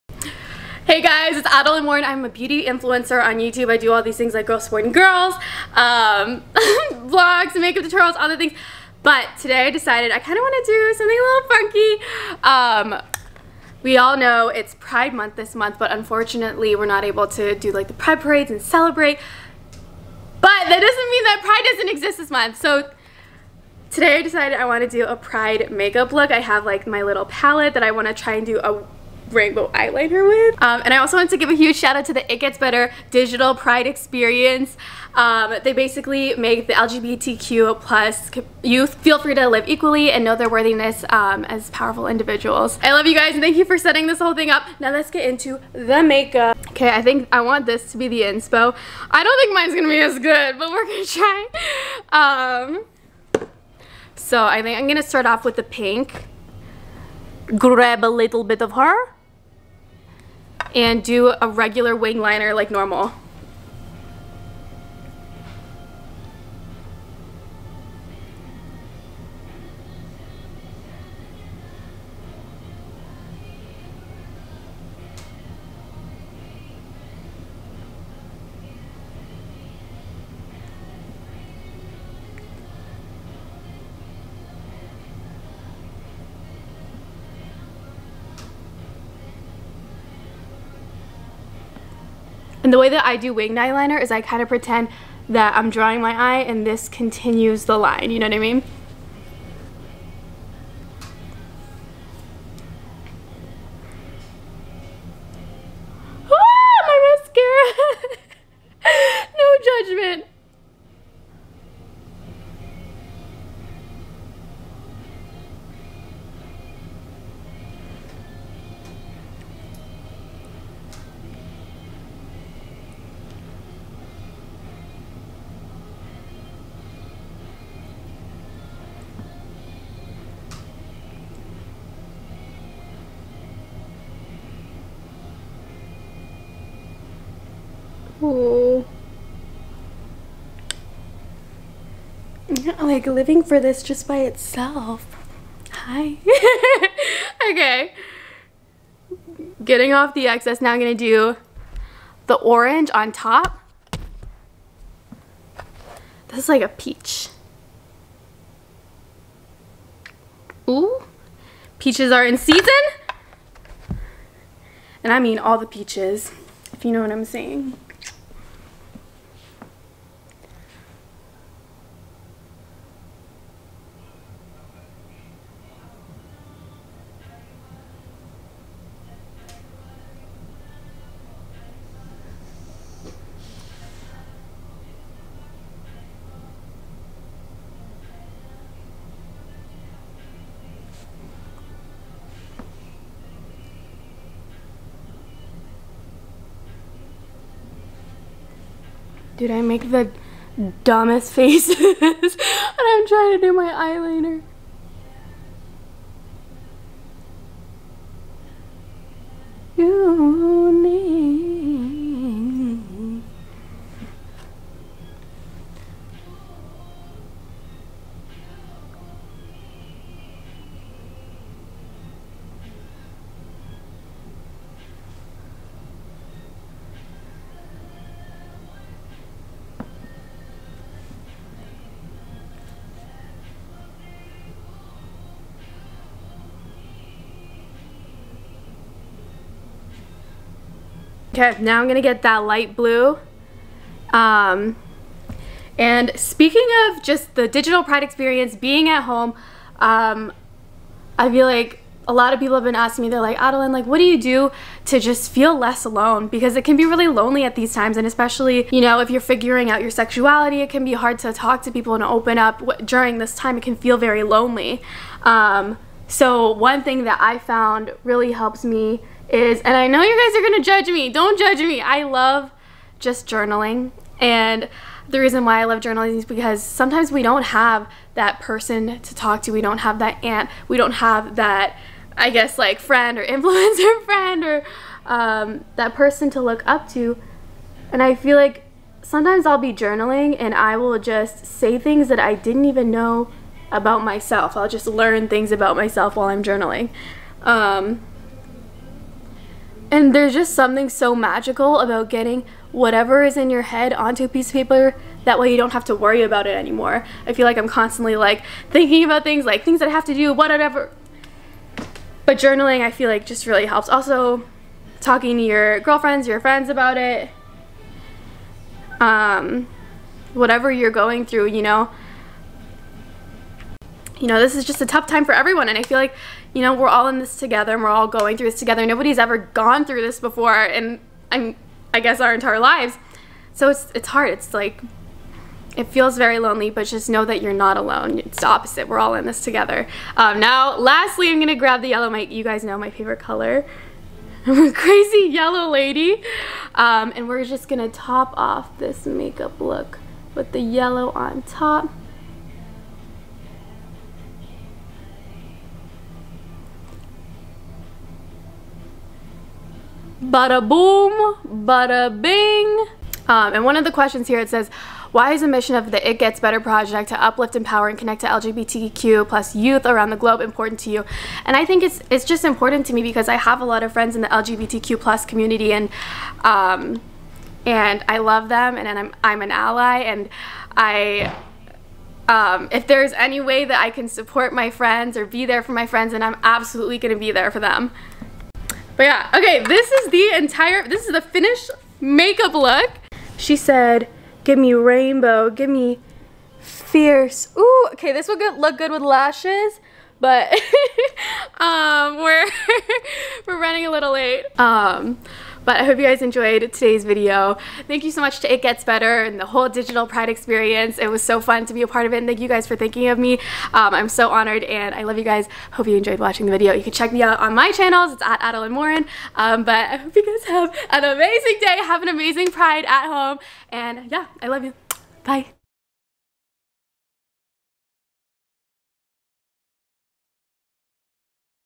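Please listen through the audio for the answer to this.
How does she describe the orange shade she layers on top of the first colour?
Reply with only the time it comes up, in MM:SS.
02:36.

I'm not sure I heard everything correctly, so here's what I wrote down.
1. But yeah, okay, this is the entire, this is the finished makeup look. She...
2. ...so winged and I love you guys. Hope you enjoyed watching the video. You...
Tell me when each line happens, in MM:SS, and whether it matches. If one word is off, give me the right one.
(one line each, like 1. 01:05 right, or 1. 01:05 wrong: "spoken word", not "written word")
1. 06:29 right
2. 06:54 wrong: "honored", not "winged".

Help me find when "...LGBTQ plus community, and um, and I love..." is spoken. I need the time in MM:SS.
06:14.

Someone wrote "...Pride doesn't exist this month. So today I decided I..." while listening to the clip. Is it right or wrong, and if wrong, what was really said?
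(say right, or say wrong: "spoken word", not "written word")
right.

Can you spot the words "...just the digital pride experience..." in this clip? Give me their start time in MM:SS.
04:07.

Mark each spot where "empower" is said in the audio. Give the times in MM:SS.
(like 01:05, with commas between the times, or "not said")
06:07.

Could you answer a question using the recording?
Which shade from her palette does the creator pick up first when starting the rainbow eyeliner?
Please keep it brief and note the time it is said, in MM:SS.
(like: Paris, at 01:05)
Pink, at 00:55.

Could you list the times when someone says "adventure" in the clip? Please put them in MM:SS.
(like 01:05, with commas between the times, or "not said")
not said.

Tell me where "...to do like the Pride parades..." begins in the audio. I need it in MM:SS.
00:17.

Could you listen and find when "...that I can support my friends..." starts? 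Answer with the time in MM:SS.
06:23.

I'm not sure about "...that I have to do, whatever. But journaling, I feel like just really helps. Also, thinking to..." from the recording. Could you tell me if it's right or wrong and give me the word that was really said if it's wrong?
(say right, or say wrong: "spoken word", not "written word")
wrong: "talking", not "thinking".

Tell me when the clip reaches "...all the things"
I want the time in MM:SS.
00:08.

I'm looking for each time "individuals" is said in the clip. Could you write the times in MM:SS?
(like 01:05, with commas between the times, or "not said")
00:42.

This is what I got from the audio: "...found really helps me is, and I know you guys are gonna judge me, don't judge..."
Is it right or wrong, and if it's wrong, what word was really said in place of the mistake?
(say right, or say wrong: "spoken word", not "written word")
right.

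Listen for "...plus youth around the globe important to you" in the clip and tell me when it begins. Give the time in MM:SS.
06:09.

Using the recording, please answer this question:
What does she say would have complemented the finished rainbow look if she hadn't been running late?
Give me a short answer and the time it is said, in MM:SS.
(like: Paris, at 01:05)
Lashes, at 06:39.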